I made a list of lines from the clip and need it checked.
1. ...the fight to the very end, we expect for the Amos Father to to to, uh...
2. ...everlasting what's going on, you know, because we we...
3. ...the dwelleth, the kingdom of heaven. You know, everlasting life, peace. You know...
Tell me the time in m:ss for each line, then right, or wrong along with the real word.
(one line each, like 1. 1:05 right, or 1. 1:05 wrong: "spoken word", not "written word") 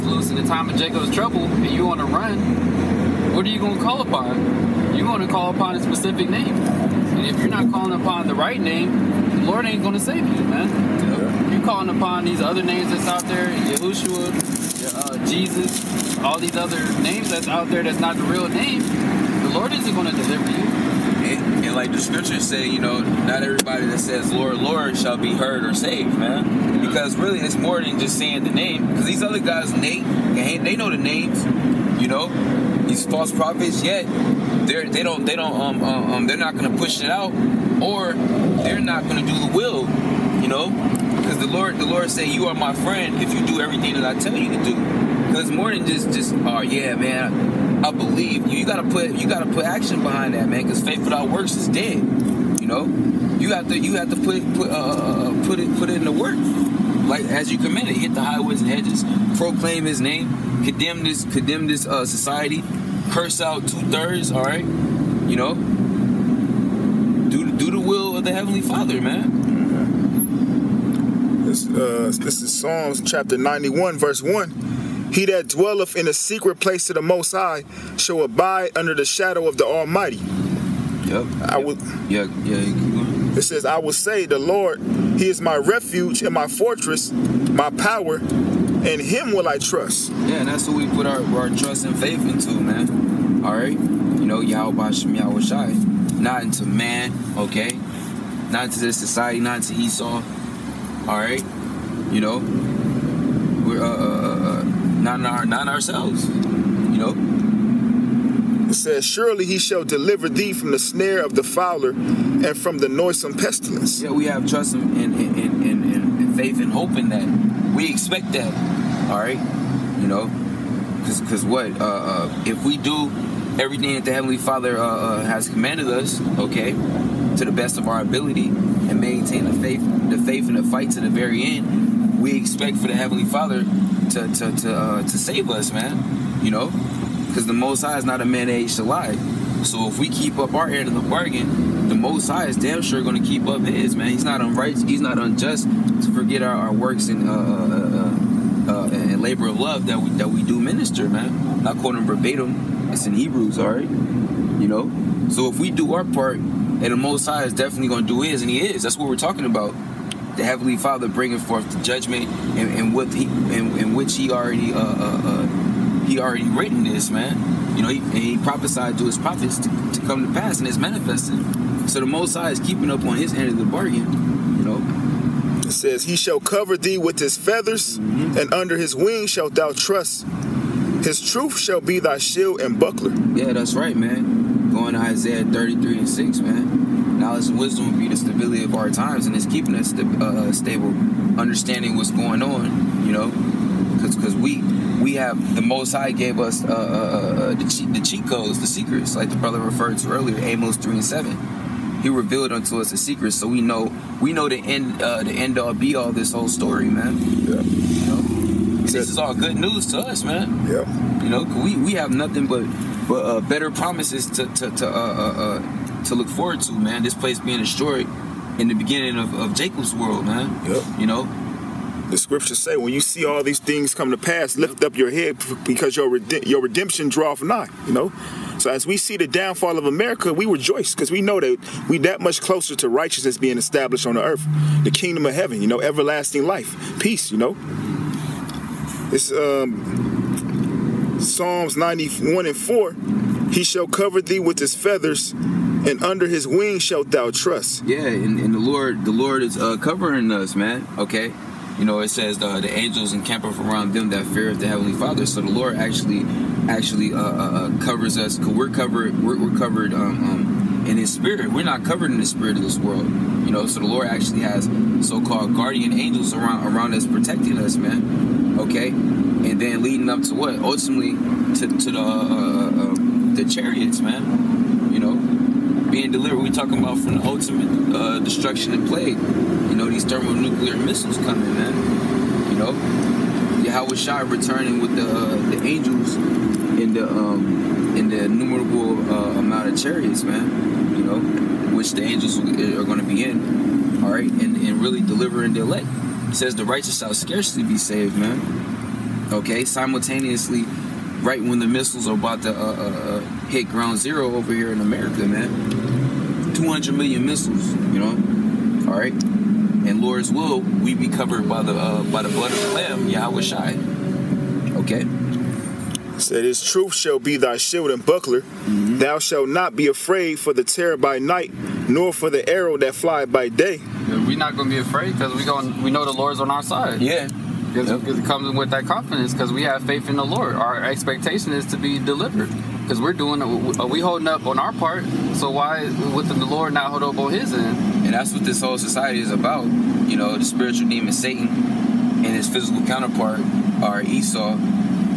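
1. 2:10 wrong: "Heavenly", not "Amos"
2. 3:11 wrong: "understanding", not "everlasting"
3. 3:54 wrong: "earth", not "dwelleth".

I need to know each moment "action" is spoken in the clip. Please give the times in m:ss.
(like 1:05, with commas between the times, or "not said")
0:49.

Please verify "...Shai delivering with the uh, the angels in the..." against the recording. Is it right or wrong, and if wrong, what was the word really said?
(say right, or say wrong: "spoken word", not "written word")
wrong: "returning", not "delivering".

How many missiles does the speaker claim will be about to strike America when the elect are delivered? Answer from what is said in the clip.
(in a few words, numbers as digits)
200 million.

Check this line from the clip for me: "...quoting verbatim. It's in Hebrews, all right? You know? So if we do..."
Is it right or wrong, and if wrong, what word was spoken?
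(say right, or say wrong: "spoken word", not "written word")
right.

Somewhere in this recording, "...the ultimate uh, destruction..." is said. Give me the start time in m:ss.
4:37.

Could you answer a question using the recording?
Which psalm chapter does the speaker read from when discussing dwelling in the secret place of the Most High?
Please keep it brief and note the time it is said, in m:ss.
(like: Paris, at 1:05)
Psalms 91, at 1:12.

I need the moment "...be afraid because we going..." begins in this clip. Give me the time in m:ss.
5:24.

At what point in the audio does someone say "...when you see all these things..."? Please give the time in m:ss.
3:42.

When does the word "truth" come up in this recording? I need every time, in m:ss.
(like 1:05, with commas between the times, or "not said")
3:01, 5:16.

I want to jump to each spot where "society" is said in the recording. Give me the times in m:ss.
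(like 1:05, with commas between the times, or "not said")
1:02, 1:38, 5:38.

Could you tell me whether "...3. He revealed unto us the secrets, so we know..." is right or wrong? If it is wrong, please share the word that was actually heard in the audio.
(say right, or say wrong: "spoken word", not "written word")
wrong: "7", not "3".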